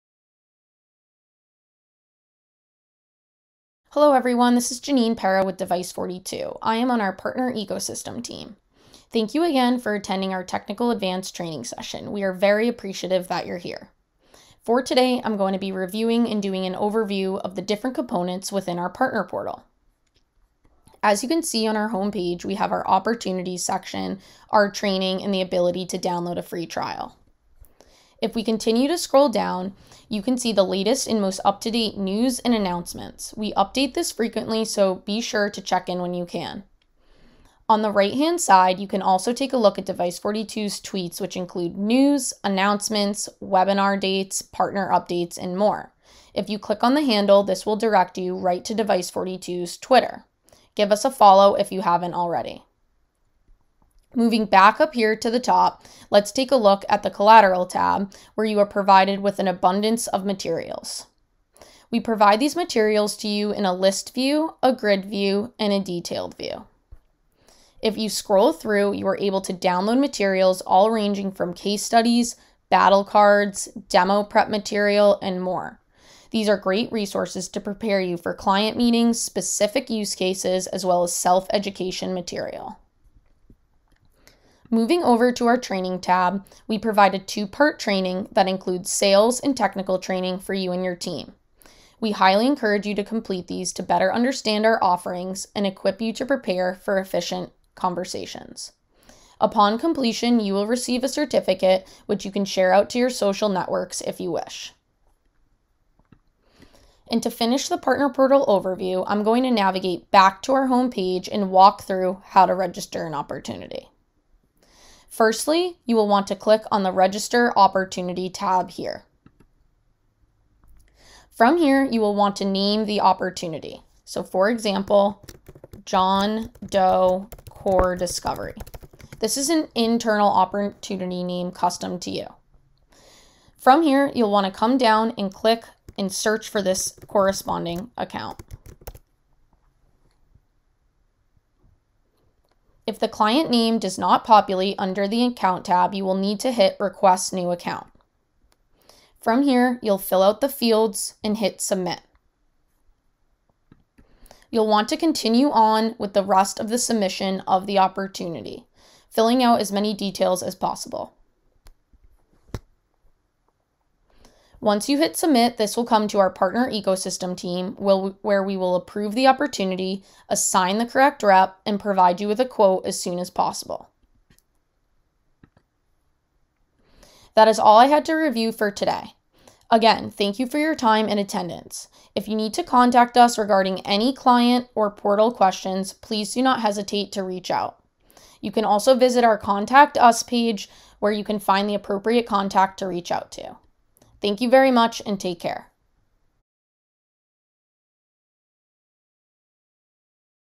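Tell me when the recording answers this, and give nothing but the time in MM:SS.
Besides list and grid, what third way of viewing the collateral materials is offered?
01:05.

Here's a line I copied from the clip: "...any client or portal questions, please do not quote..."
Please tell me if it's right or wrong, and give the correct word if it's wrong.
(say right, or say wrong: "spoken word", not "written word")
wrong: "hesitate", not "quote".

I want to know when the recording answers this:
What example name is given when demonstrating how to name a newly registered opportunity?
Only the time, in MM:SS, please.
02:05.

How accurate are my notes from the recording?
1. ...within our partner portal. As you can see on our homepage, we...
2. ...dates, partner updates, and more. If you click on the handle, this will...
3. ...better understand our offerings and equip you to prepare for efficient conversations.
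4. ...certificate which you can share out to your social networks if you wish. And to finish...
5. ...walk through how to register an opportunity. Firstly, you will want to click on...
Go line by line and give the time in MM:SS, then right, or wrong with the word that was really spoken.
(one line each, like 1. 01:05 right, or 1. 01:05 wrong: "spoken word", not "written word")
1. 00:18 right
2. 00:43 right
3. 01:33 right
4. 01:41 right
5. 01:51 right.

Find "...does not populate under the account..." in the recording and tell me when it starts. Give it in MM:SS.
02:23.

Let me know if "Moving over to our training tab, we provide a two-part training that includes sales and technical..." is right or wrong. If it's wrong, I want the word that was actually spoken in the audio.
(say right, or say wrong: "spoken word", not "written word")
right.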